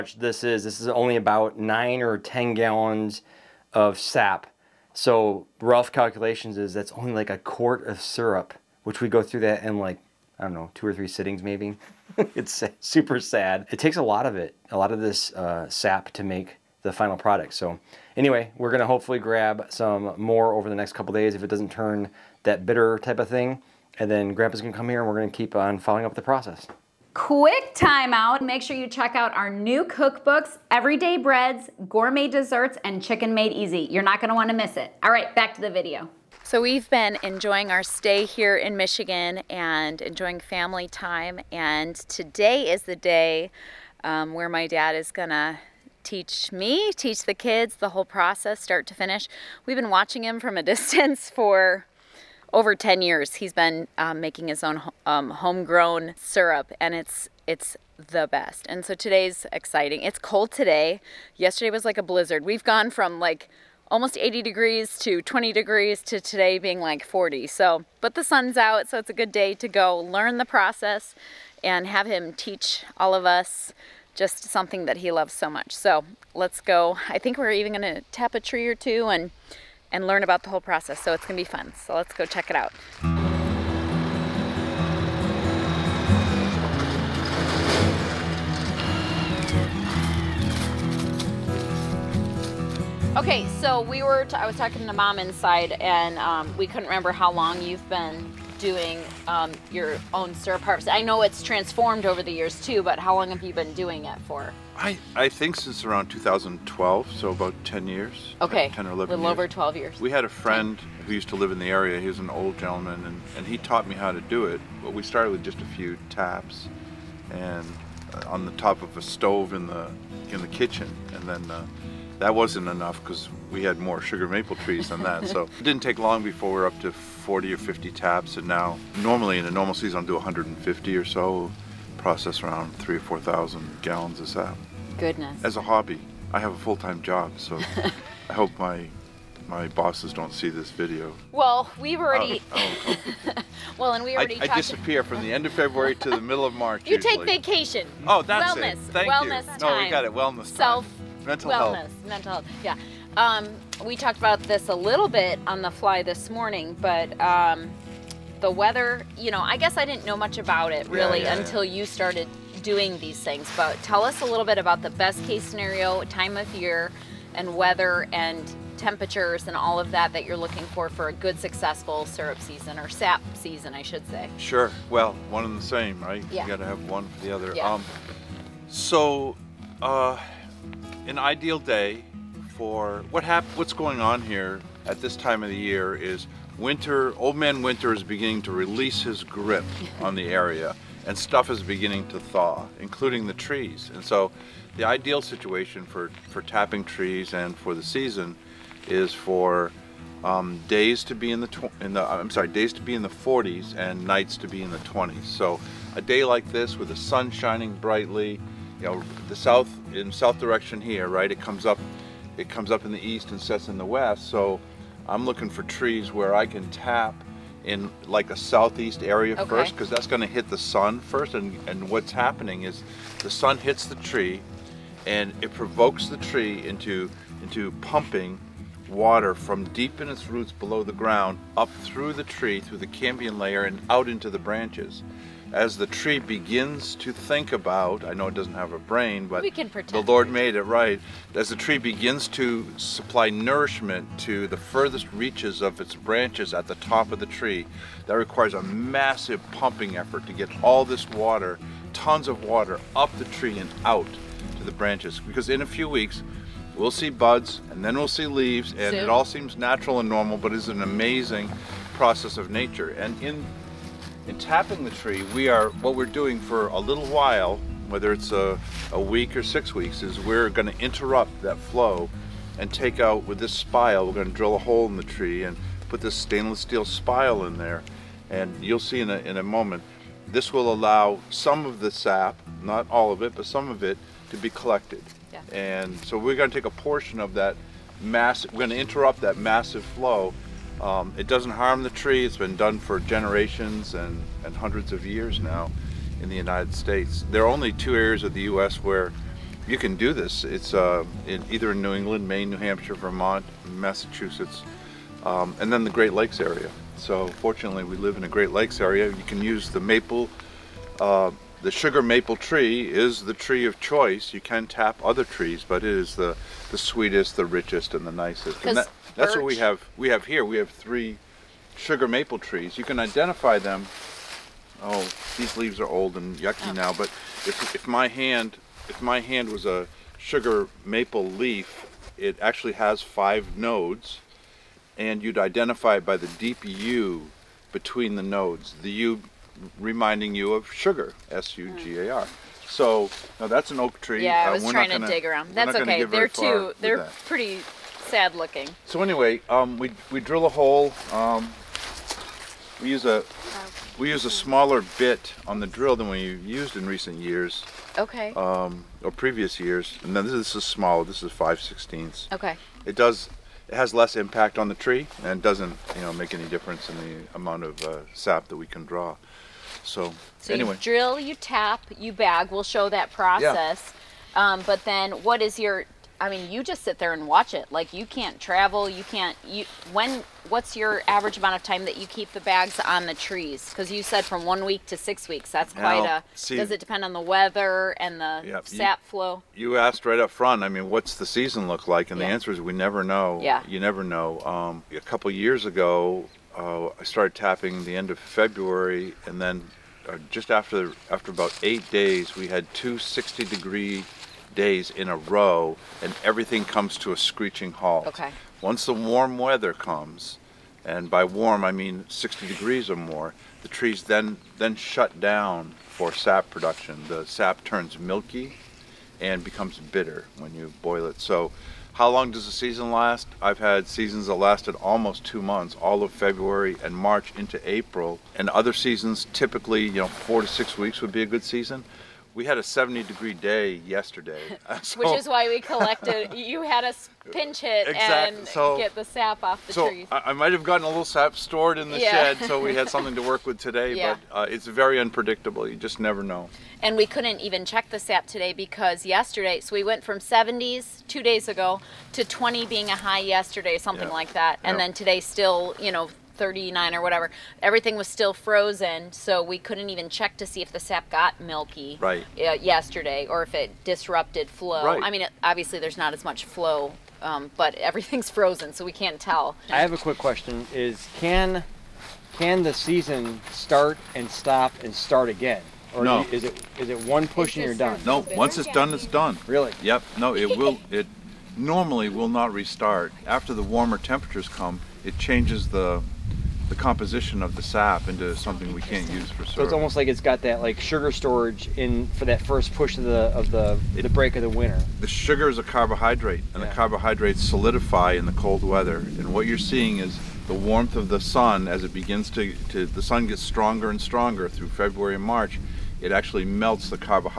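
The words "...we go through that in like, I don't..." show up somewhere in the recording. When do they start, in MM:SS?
00:09.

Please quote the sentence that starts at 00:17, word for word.
So anyway, we're gonna hopefully grab some more over the next couple days if it doesn't turn that bitter type of thing.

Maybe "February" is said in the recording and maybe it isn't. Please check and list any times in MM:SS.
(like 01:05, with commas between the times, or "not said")
02:25, 06:38, 07:06, 08:24.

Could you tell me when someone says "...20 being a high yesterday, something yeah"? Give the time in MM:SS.
07:32.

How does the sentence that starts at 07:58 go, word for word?
No, once it's done, it's done.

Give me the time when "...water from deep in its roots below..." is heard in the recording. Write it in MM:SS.
03:48.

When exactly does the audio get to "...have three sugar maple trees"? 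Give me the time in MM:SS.
05:20.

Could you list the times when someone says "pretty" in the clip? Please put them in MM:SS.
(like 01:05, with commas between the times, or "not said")
05:47.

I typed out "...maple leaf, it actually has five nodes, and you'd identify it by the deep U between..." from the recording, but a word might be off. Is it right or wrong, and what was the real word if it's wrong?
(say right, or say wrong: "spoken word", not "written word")
right.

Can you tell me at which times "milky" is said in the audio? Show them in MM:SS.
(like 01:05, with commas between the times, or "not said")
06:57, 07:41.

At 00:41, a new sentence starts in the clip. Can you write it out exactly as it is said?
And today is the day um, where my dad is gonna teach me, teach the kids the whole process, start to finish.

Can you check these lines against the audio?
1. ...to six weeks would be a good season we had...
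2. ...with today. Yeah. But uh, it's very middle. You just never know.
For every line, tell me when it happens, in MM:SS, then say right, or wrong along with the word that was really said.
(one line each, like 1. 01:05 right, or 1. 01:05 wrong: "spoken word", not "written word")
1. 07:10 right
2. 07:23 wrong: "unpredictable", not "middle".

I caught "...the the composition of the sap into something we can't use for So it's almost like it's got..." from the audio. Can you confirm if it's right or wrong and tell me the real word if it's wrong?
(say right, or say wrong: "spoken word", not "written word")
right.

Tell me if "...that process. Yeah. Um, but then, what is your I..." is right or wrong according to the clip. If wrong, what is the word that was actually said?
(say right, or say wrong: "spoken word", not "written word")
right.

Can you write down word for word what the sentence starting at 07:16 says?
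you had us pinch it exactly.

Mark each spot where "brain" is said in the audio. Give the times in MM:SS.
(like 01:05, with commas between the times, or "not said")
03:58.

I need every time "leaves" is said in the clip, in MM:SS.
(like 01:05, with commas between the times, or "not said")
04:18, 05:25.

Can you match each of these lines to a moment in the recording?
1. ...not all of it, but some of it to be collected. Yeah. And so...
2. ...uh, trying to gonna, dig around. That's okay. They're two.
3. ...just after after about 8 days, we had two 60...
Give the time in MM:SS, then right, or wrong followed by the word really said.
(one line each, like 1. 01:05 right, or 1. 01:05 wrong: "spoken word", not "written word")
1. 04:42 right
2. 05:44 right
3. 06:40 right.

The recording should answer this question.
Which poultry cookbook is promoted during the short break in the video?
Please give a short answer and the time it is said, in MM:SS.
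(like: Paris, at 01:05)
Chicken Made Easy, at 00:33.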